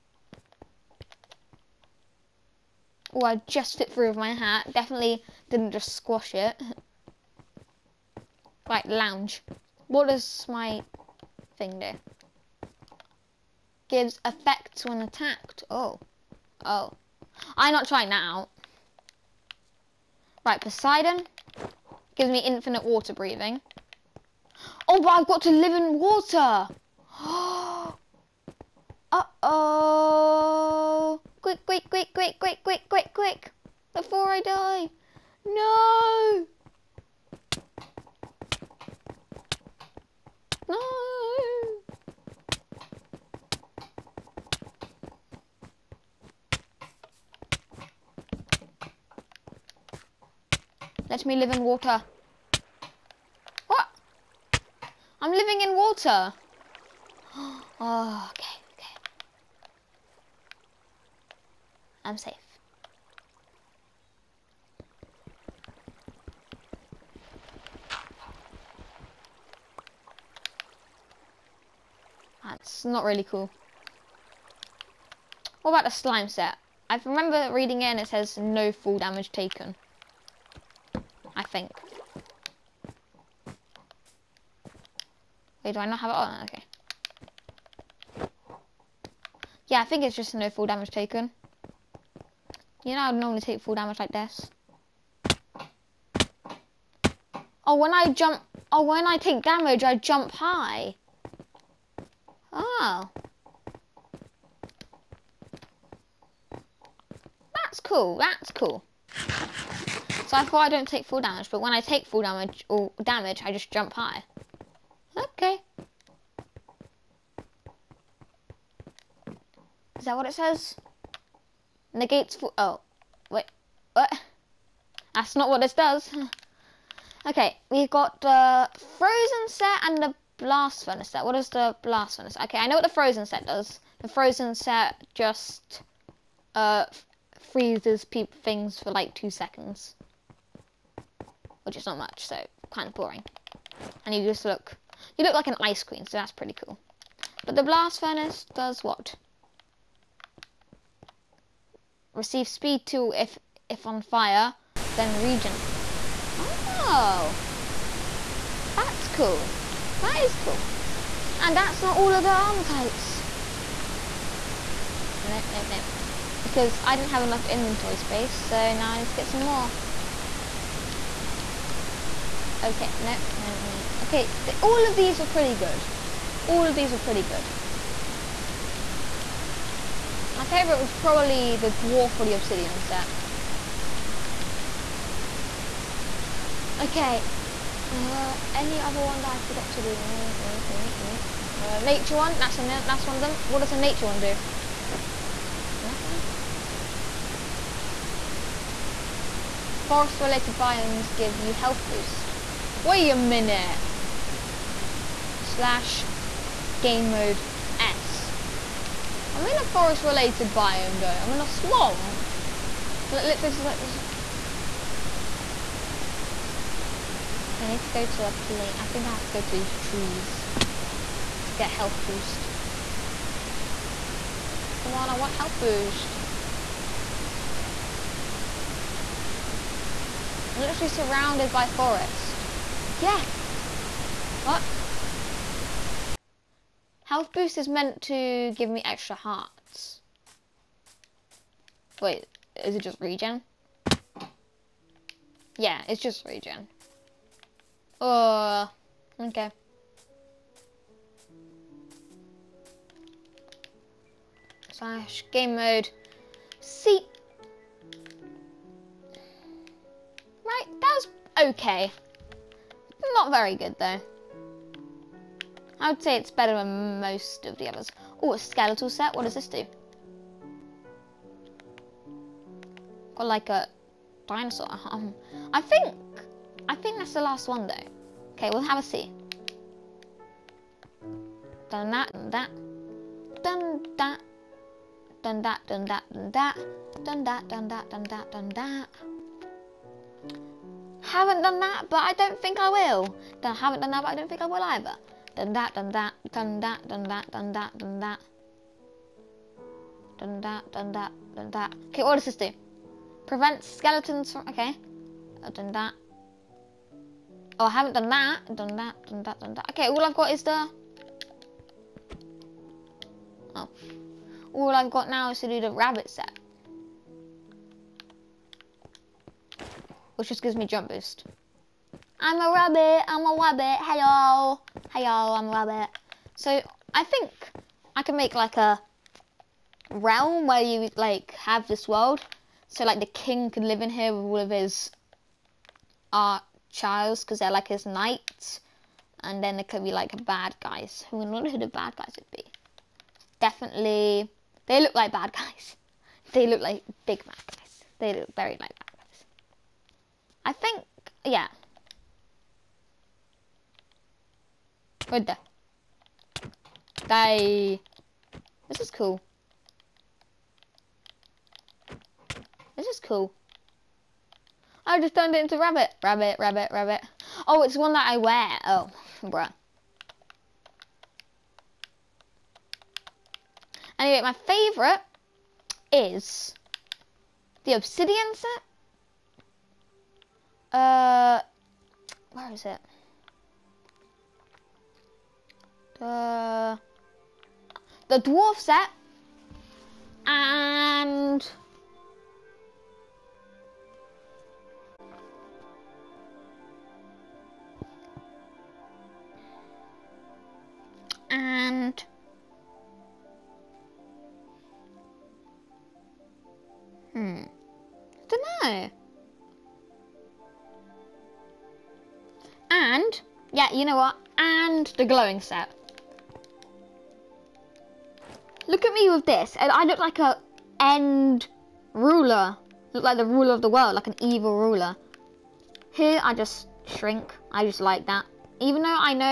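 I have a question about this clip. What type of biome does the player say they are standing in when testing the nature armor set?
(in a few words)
a swamp.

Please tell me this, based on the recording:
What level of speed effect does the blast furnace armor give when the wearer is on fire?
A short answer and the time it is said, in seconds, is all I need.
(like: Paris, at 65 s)
speed 2, at 152 s.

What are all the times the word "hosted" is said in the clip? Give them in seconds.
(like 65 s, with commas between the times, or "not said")
not said.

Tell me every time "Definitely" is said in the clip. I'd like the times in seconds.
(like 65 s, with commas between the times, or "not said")
4 s, 343 s.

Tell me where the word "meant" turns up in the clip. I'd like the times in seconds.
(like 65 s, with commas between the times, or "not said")
237 s.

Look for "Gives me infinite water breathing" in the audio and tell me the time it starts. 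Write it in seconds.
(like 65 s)
22 s.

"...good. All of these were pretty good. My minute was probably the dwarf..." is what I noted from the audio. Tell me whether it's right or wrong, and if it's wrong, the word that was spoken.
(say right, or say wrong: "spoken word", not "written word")
wrong: "favorite", not "minute".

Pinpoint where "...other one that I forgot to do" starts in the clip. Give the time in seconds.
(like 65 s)
188 s.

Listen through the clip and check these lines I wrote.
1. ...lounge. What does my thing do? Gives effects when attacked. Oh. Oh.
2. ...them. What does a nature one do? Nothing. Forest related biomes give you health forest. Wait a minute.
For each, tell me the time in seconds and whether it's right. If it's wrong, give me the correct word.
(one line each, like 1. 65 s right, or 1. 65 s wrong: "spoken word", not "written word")
1. 8 s right
2. 193 s wrong: "boost", not "forest".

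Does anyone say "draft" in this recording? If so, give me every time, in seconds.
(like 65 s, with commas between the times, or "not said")
not said.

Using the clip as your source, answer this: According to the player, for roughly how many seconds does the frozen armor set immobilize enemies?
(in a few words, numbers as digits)
2 seconds.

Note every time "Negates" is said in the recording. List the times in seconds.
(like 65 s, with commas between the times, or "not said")
121 s.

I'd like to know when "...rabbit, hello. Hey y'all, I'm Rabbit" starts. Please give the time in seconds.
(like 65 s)
323 s.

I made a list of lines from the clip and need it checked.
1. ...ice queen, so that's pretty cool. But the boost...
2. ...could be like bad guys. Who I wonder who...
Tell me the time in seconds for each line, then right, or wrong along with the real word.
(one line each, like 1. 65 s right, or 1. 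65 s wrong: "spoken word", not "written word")
1. 145 s wrong: "blast", not "boost"
2. 339 s right.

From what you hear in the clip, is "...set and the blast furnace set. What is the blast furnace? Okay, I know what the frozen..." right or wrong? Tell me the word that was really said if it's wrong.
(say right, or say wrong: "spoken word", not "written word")
right.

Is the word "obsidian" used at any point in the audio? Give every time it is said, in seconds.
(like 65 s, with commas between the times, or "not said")
182 s, 377 s.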